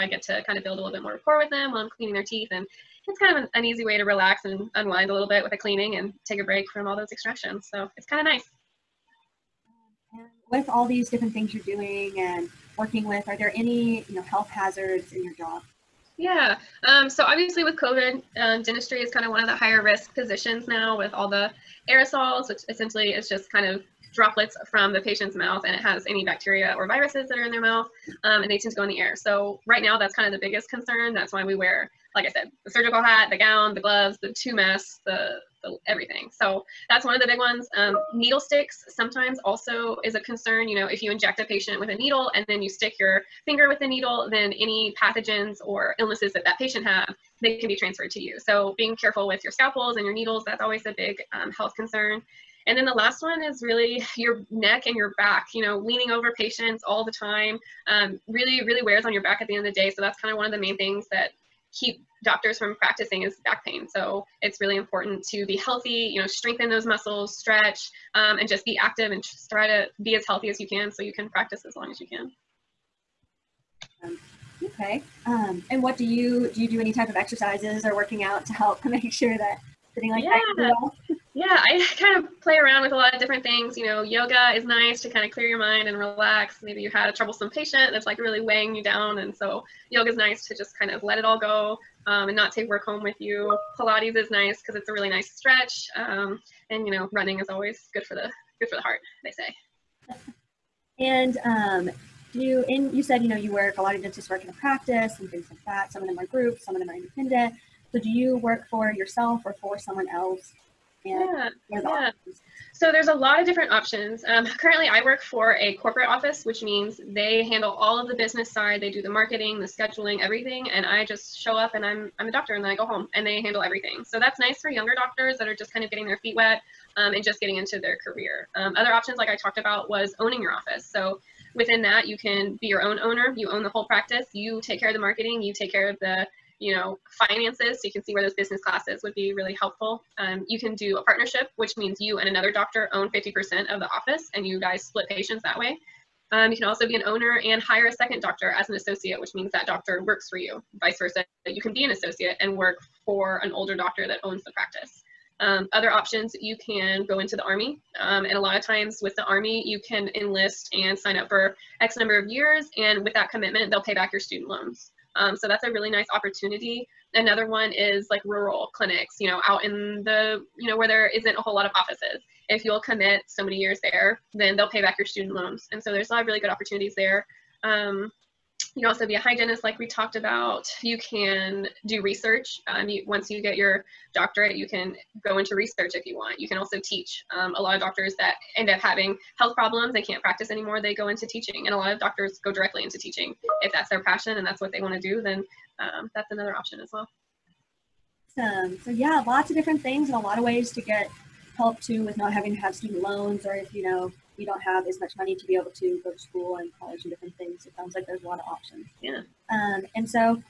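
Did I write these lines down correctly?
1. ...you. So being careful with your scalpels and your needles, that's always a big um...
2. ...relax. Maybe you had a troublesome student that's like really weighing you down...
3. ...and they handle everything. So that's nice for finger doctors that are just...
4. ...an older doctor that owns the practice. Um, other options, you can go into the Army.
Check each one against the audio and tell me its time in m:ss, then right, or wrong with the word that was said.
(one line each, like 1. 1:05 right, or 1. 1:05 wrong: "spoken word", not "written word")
1. 0:48 right
2. 1:25 wrong: "patient", not "student"
3. 2:03 wrong: "younger", not "finger"
4. 2:33 right.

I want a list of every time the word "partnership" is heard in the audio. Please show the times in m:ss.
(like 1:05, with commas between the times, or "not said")
2:21.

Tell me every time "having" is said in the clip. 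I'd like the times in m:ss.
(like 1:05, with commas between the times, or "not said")
3:08, 3:22.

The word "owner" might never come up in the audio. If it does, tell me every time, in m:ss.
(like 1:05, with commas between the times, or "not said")
2:12, 2:27.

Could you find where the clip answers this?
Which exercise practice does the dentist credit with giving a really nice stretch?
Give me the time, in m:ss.
1:33.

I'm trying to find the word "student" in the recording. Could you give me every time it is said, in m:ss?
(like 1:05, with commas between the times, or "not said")
2:44, 2:55, 3:22.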